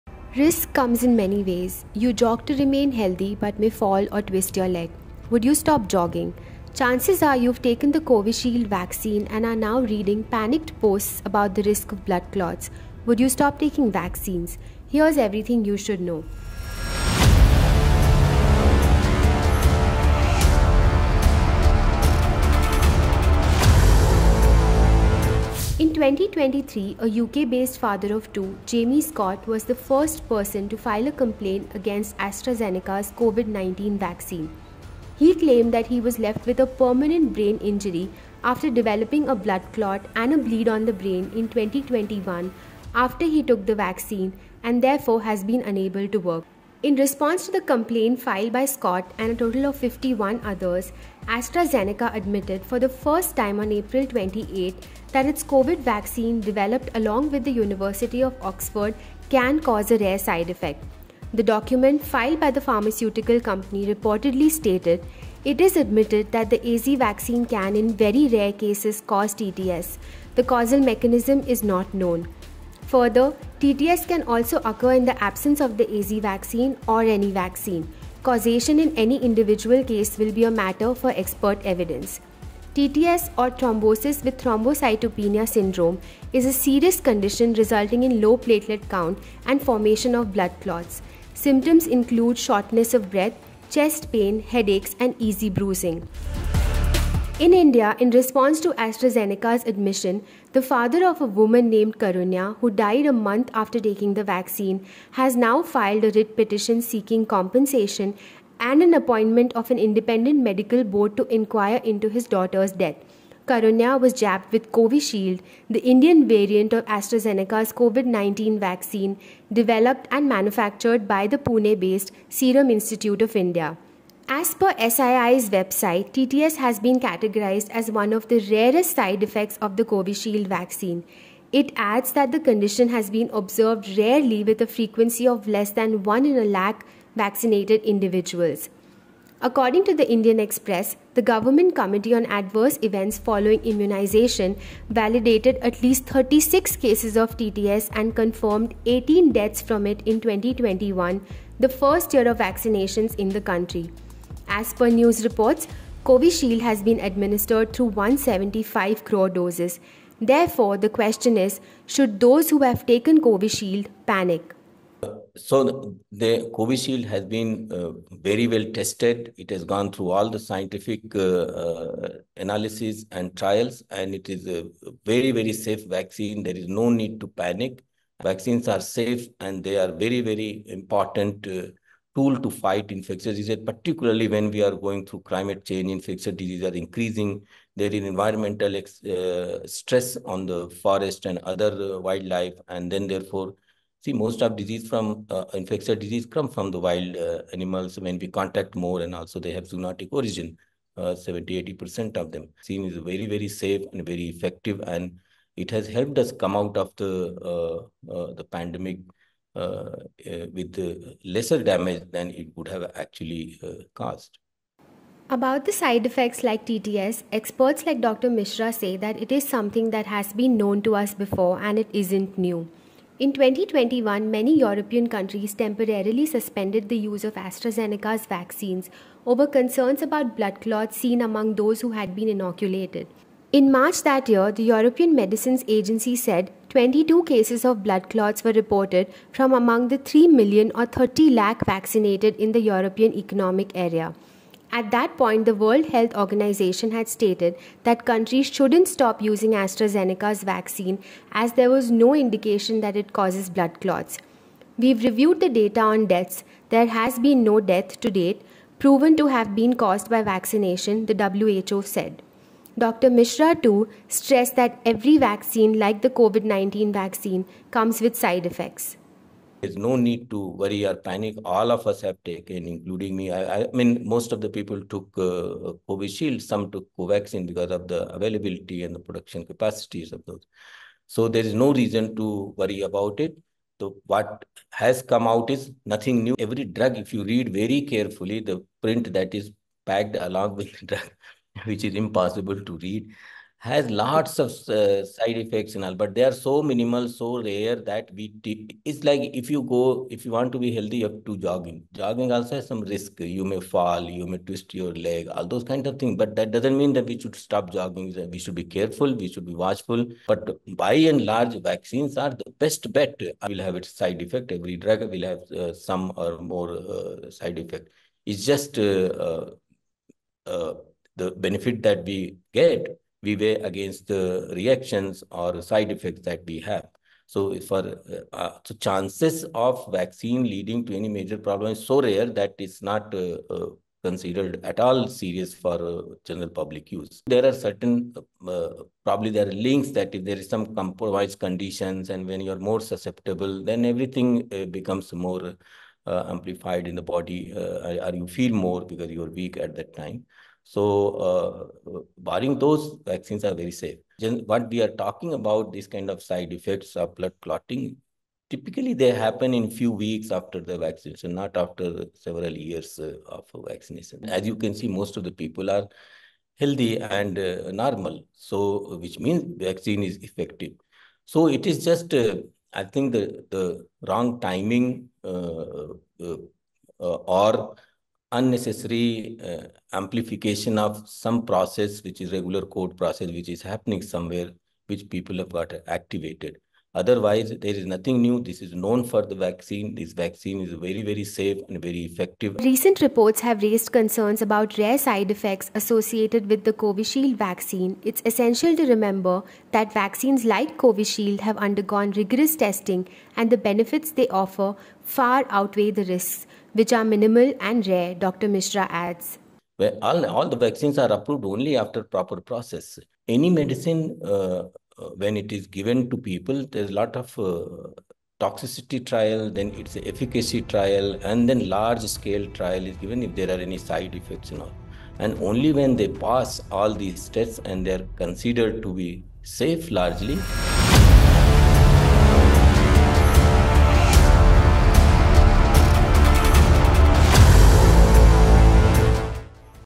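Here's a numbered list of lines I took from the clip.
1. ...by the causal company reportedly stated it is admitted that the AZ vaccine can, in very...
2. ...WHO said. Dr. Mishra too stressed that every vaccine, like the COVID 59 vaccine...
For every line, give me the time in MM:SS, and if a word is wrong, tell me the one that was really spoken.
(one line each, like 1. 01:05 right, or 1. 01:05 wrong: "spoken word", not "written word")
1. 01:02 wrong: "pharmaceutical", not "causal"
2. 04:21 wrong: "19", not "59".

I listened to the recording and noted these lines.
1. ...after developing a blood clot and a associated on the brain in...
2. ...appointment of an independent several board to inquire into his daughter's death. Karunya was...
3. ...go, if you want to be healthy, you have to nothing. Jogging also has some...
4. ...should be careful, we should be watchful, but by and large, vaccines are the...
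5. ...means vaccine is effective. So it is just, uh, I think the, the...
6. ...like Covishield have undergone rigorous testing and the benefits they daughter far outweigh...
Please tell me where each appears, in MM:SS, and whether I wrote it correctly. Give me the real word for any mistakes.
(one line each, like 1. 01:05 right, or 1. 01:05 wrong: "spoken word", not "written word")
1. 00:38 wrong: "bleed", not "associated"
2. 01:48 wrong: "medical", not "several"
3. 04:59 wrong: "jogging", not "nothing"
4. 05:08 right
5. 06:09 right
6. 06:40 wrong: "offer", not "daughter".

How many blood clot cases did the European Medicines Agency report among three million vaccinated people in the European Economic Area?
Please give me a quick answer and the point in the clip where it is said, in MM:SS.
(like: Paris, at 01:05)
22, at 03:56.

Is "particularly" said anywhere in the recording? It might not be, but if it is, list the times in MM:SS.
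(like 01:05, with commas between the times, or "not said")
03:03.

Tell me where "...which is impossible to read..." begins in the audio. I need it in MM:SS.
04:51.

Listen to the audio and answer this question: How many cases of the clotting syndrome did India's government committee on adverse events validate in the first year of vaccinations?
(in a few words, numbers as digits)
36.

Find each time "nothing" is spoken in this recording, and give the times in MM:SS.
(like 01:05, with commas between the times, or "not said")
04:45, 06:27.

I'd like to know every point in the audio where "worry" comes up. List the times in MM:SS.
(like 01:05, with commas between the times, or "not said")
04:30, 04:42.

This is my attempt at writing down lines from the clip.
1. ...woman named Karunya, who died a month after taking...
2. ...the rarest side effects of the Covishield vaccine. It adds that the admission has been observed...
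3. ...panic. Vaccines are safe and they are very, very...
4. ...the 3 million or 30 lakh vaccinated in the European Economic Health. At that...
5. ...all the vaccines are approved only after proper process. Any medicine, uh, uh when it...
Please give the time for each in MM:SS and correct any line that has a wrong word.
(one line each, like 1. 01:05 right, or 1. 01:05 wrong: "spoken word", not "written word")
1. 01:41 right
2. 02:08 wrong: "condition", not "admission"
3. 02:57 right
4. 03:59 wrong: "Area", not "Health"
5. 06:50 right.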